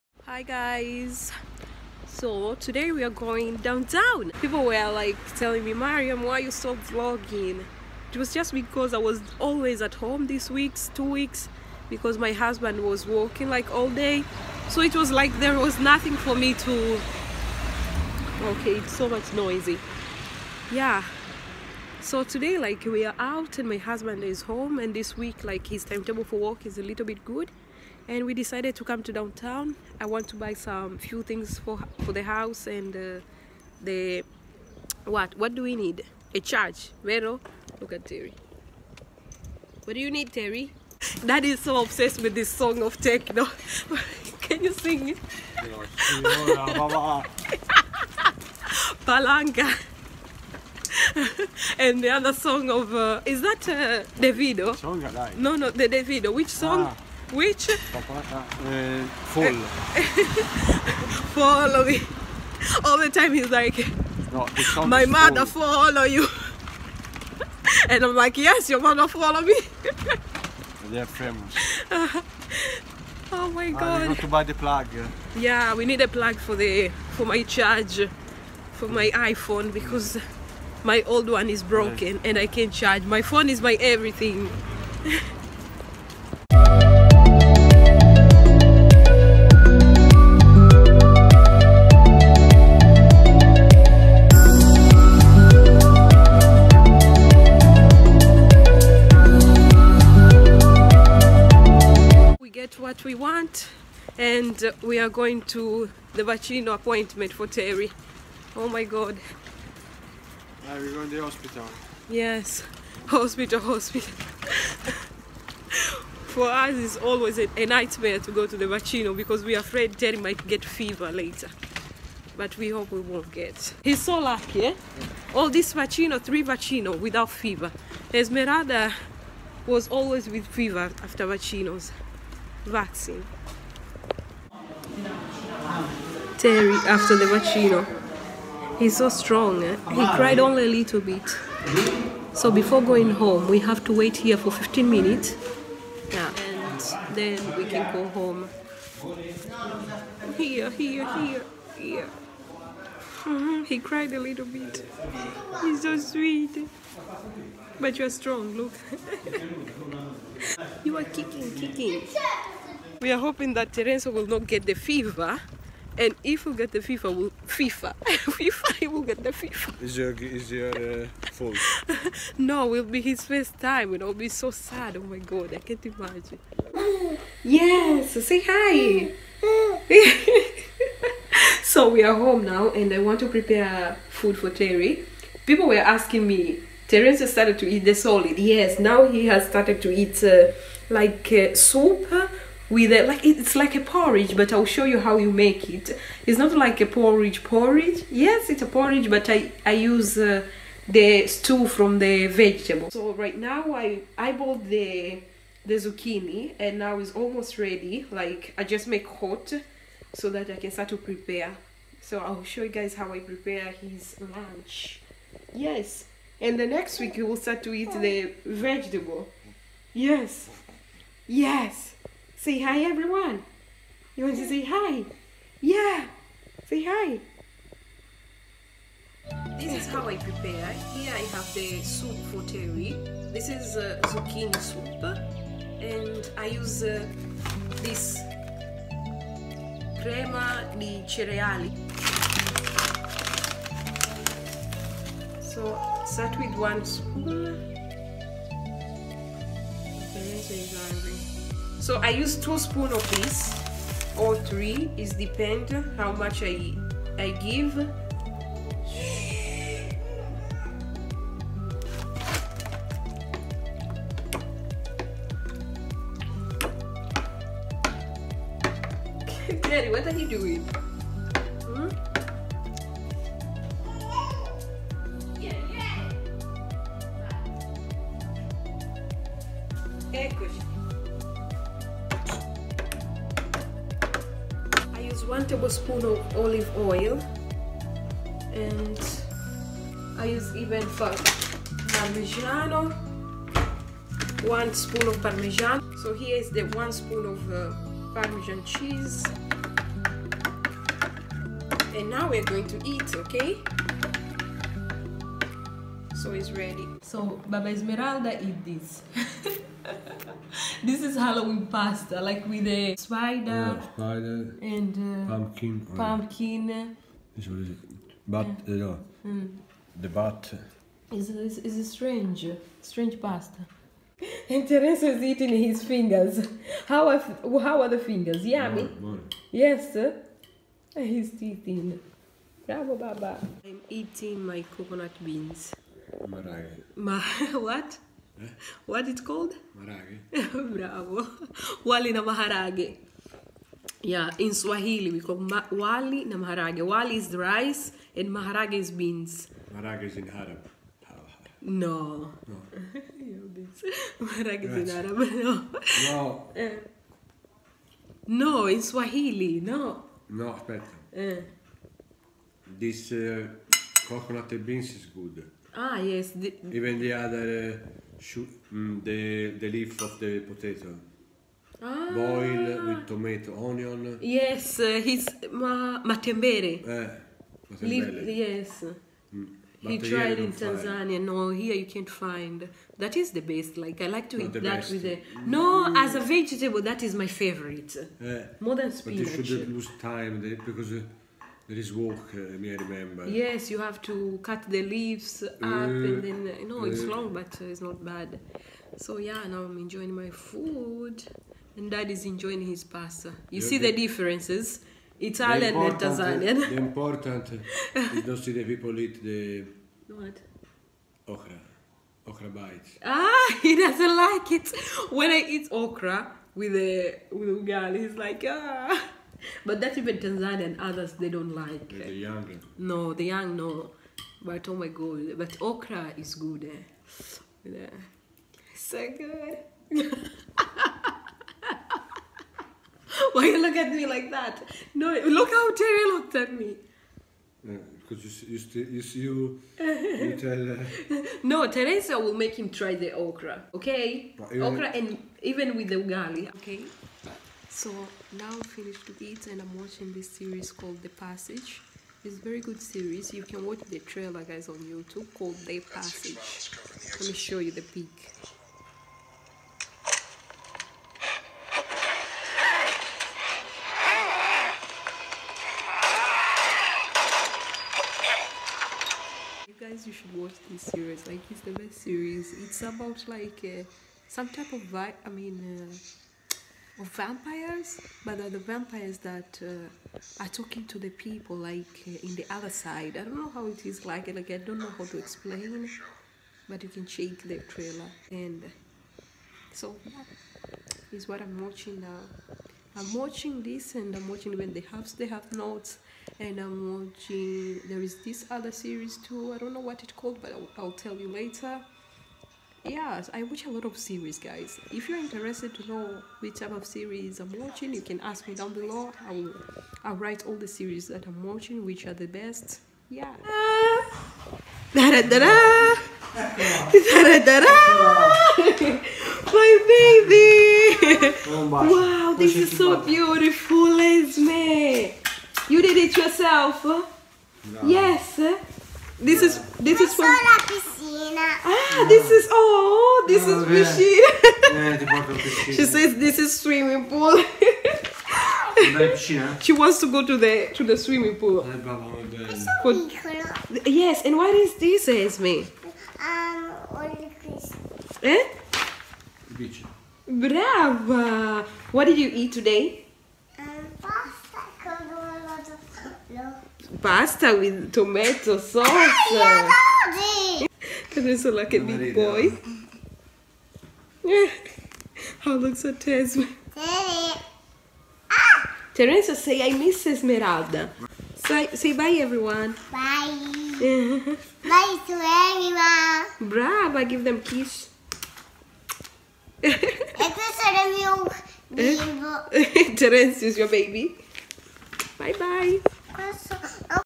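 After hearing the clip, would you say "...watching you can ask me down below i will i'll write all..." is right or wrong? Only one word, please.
right.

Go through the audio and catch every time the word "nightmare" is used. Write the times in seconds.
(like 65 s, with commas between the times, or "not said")
117 s.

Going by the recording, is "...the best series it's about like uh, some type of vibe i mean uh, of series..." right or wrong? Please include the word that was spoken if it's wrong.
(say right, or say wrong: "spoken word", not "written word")
wrong: "vampires", not "series".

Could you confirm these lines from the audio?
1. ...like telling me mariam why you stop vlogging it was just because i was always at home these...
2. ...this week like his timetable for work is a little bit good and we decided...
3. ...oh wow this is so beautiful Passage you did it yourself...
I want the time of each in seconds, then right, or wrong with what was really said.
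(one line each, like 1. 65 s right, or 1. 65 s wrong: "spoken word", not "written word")
1. 4 s right
2. 24 s right
3. 521 s wrong: "Esme", not "Passage".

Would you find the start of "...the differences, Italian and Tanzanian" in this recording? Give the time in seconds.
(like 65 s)
403 s.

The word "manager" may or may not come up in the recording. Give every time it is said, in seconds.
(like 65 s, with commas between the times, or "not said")
not said.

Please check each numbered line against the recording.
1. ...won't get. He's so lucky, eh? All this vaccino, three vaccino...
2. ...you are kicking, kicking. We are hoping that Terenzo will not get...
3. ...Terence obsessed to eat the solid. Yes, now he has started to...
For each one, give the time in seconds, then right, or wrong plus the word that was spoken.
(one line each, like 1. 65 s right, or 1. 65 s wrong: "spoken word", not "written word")
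1. 122 s right
2. 160 s right
3. 186 s wrong: "started", not "obsessed".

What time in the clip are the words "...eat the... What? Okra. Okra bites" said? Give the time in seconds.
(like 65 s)
408 s.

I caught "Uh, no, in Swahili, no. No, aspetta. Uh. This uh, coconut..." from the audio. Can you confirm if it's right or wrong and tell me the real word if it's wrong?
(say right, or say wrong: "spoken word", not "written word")
right.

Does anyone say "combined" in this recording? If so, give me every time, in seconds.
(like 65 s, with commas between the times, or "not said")
not said.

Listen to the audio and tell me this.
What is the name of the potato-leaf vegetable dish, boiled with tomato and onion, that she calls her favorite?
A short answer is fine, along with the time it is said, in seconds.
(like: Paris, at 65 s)
matembele, at 377 s.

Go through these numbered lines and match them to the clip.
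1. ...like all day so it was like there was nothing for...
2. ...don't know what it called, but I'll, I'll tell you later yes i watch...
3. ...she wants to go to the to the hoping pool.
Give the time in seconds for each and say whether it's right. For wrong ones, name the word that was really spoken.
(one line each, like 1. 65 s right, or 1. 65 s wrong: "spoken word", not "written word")
1. 13 s right
2. 499 s right
3. 539 s wrong: "swimming", not "hoping".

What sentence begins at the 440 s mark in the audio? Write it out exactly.
Uh, no, Teresa will make him try the okra.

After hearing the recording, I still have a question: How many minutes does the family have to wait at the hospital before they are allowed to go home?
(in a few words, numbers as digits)
15.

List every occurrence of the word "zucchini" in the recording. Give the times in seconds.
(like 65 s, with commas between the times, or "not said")
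205 s, 234 s.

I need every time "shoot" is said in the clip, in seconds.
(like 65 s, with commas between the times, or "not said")
368 s.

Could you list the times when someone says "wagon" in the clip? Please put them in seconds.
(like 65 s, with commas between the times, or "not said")
not said.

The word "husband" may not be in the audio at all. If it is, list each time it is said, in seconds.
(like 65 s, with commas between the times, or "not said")
12 s, 23 s.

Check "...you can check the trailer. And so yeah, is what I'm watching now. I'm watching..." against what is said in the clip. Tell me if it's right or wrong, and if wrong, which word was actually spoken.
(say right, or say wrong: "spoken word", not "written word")
right.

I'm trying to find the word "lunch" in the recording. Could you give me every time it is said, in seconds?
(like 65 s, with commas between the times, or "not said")
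214 s.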